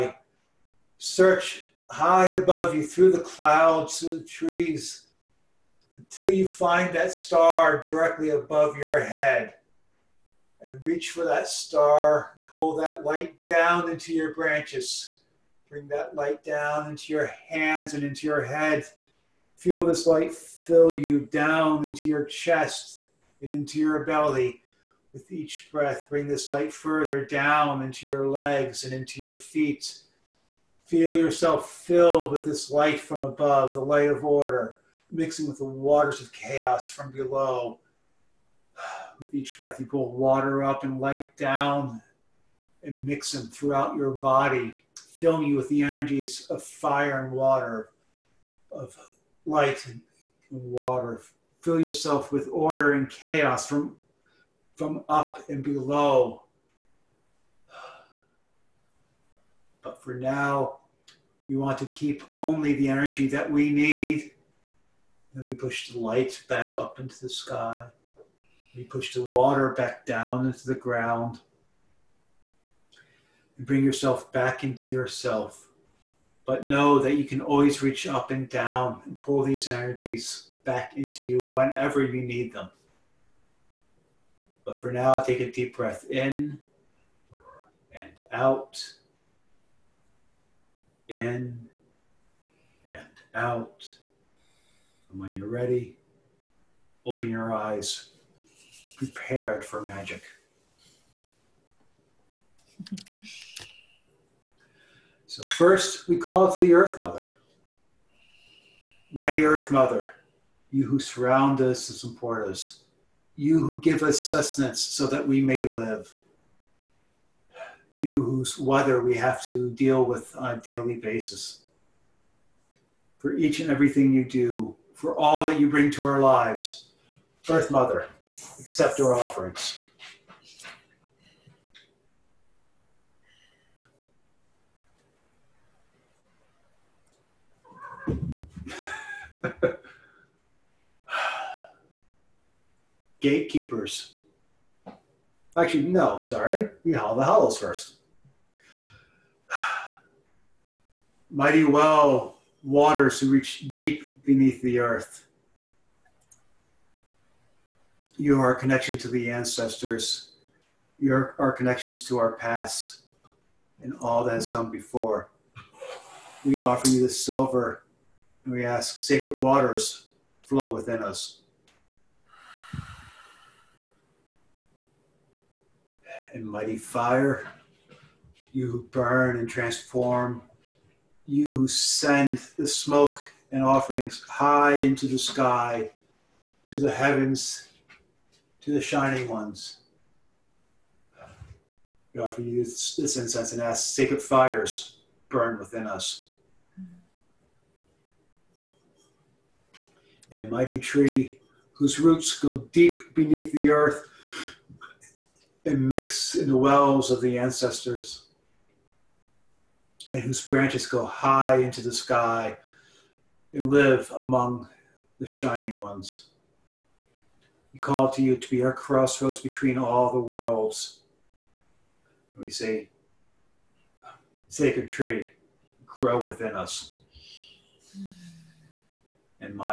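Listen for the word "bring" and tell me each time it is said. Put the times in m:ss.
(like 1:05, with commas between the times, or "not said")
0:15, 0:26, 1:13, 2:05.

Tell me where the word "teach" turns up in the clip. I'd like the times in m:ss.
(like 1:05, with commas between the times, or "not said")
not said.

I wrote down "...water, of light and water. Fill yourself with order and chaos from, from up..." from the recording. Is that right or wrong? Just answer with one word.
right.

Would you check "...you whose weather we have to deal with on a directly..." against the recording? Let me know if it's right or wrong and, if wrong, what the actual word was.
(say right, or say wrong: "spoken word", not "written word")
wrong: "daily", not "directly".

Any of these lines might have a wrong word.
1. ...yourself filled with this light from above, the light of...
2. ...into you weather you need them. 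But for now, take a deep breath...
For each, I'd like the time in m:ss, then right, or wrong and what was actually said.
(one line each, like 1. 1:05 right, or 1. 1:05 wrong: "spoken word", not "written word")
1. 0:31 right
2. 1:20 wrong: "whenever", not "weather".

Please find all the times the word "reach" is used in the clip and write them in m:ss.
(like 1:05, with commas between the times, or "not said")
0:10, 1:17, 2:33.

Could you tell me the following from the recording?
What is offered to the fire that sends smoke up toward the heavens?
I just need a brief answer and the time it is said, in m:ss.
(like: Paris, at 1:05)
incense, at 3:13.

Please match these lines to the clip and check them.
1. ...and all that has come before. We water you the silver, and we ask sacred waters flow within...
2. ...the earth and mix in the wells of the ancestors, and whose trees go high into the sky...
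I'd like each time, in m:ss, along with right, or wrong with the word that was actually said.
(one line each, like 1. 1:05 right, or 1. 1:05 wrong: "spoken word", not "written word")
1. 2:43 wrong: "offer", not "water"
2. 3:23 wrong: "branches", not "trees".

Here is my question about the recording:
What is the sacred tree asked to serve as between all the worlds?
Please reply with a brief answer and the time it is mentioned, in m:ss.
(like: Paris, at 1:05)
crossroads, at 3:38.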